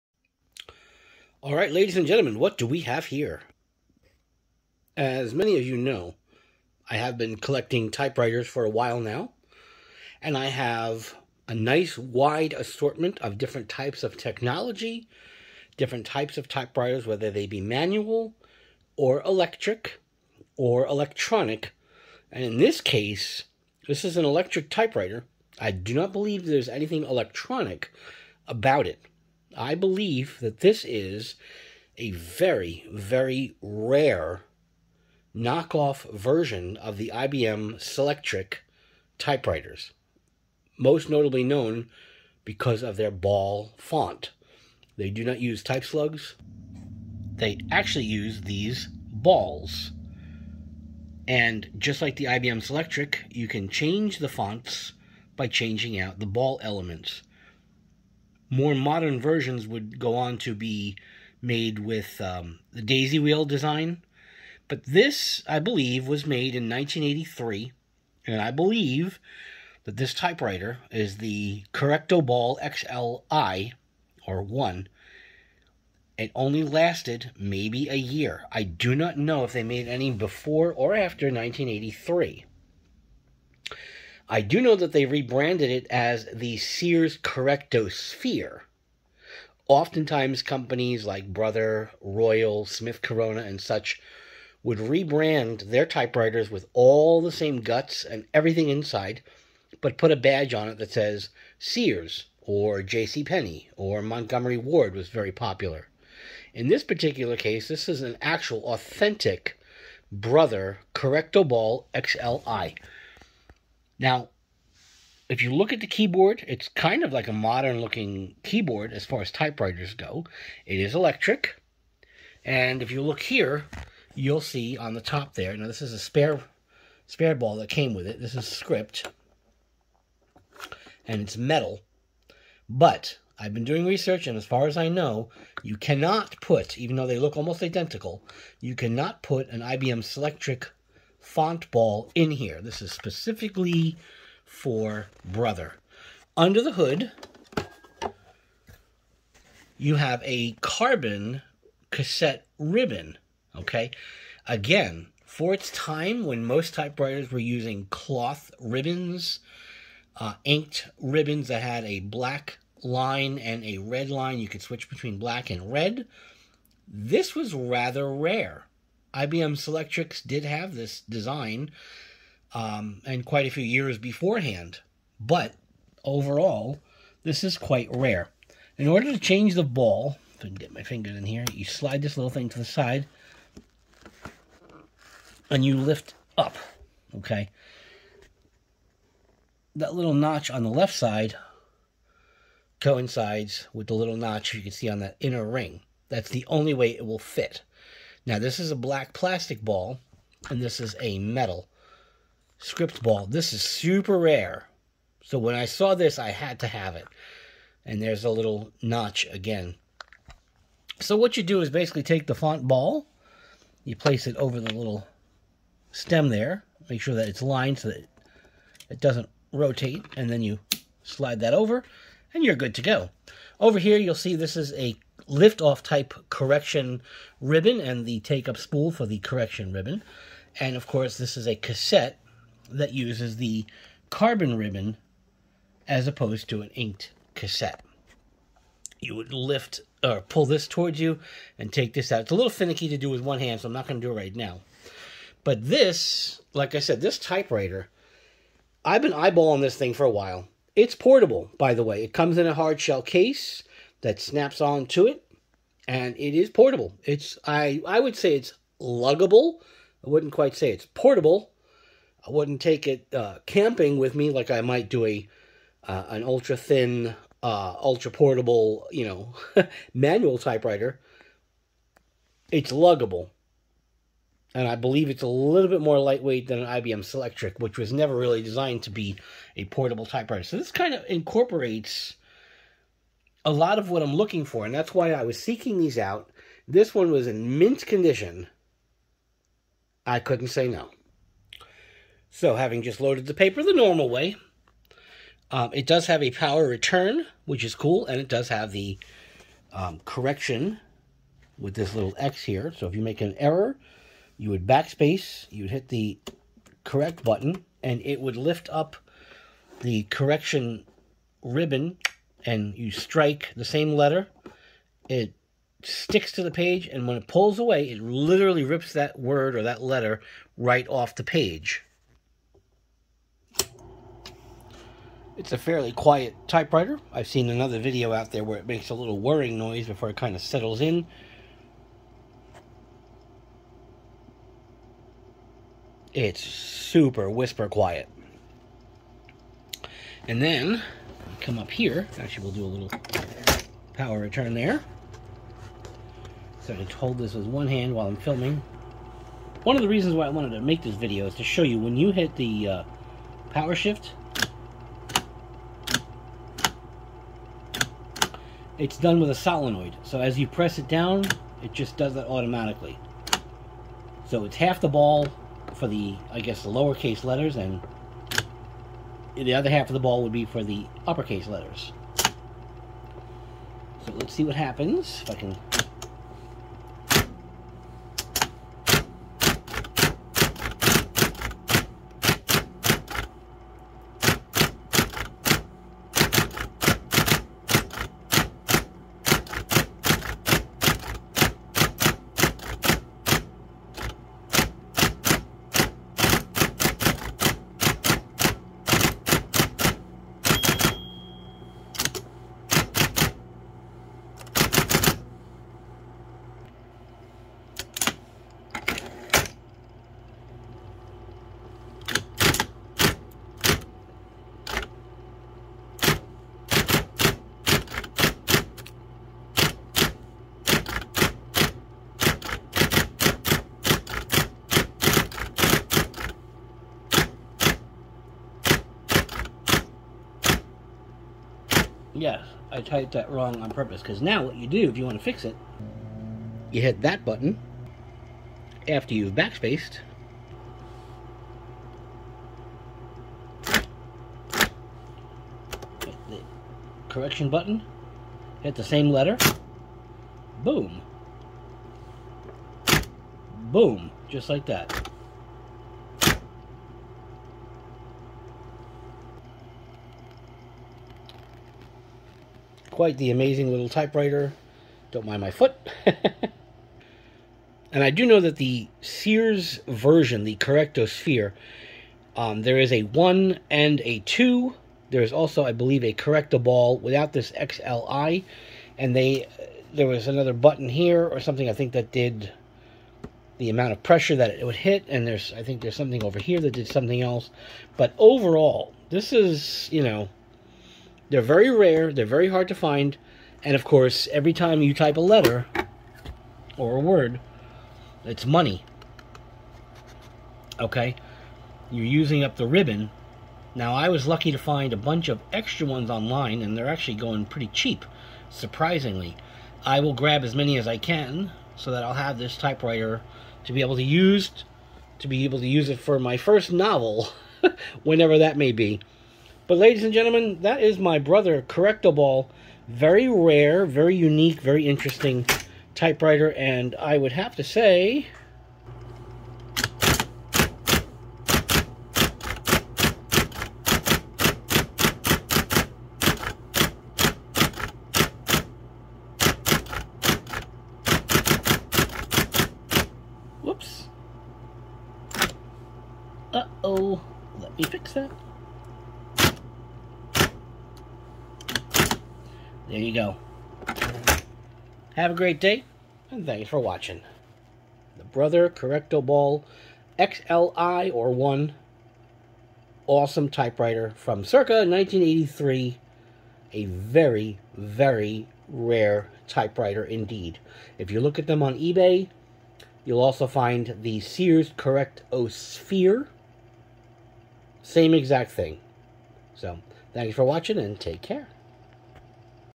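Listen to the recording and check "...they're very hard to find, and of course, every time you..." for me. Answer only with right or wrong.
right.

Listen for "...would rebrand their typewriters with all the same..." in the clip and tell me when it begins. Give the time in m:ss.
1:34.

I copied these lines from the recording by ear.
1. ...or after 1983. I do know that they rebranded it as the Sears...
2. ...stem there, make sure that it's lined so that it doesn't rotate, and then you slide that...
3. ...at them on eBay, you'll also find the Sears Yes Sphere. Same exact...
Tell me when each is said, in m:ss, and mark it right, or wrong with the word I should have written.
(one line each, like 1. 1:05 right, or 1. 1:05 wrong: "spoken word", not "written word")
1. 1:20 right
2. 3:35 right
3. 9:31 wrong: "Correcto", not "Yes".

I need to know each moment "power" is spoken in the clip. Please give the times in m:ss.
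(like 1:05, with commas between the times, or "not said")
4:56, 5:43, 5:53.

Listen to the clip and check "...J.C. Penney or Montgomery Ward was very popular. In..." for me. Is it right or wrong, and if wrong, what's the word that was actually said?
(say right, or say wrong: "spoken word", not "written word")
right.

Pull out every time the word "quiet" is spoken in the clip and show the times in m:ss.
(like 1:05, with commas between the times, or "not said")
5:25, 5:37.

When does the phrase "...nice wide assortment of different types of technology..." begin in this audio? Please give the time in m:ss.
0:11.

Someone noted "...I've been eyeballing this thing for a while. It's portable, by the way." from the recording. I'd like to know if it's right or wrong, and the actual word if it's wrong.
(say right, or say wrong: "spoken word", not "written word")
right.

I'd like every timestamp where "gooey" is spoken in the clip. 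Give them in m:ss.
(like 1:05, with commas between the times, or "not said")
not said.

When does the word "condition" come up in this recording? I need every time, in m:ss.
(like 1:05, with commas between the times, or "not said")
4:47.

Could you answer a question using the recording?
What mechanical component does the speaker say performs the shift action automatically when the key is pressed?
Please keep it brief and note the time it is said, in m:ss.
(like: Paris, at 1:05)
solenoid, at 5:59.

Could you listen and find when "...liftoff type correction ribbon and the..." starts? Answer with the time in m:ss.
3:45.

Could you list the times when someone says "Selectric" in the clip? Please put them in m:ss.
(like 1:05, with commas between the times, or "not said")
0:37, 0:52, 2:20, 2:49, 4:37.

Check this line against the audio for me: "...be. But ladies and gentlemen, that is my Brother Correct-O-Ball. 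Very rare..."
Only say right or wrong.
right.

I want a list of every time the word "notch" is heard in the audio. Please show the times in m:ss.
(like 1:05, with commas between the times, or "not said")
3:10, 3:14, 3:28.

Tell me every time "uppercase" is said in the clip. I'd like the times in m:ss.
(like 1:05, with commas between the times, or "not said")
6:11.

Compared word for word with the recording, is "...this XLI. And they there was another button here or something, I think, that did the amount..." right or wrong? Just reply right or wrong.
right.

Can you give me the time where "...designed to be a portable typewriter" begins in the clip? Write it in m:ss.
4:38.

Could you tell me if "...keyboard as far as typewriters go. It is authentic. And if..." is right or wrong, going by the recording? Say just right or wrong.
wrong.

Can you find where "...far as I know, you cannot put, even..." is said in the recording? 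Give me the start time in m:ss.
2:14.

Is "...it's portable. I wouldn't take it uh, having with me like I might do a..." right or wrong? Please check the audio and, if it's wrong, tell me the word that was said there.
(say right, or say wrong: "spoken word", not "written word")
wrong: "camping", not "having".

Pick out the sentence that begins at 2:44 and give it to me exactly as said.
You could switch between black and red.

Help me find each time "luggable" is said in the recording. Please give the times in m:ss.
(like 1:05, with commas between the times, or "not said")
4:18, 4:32.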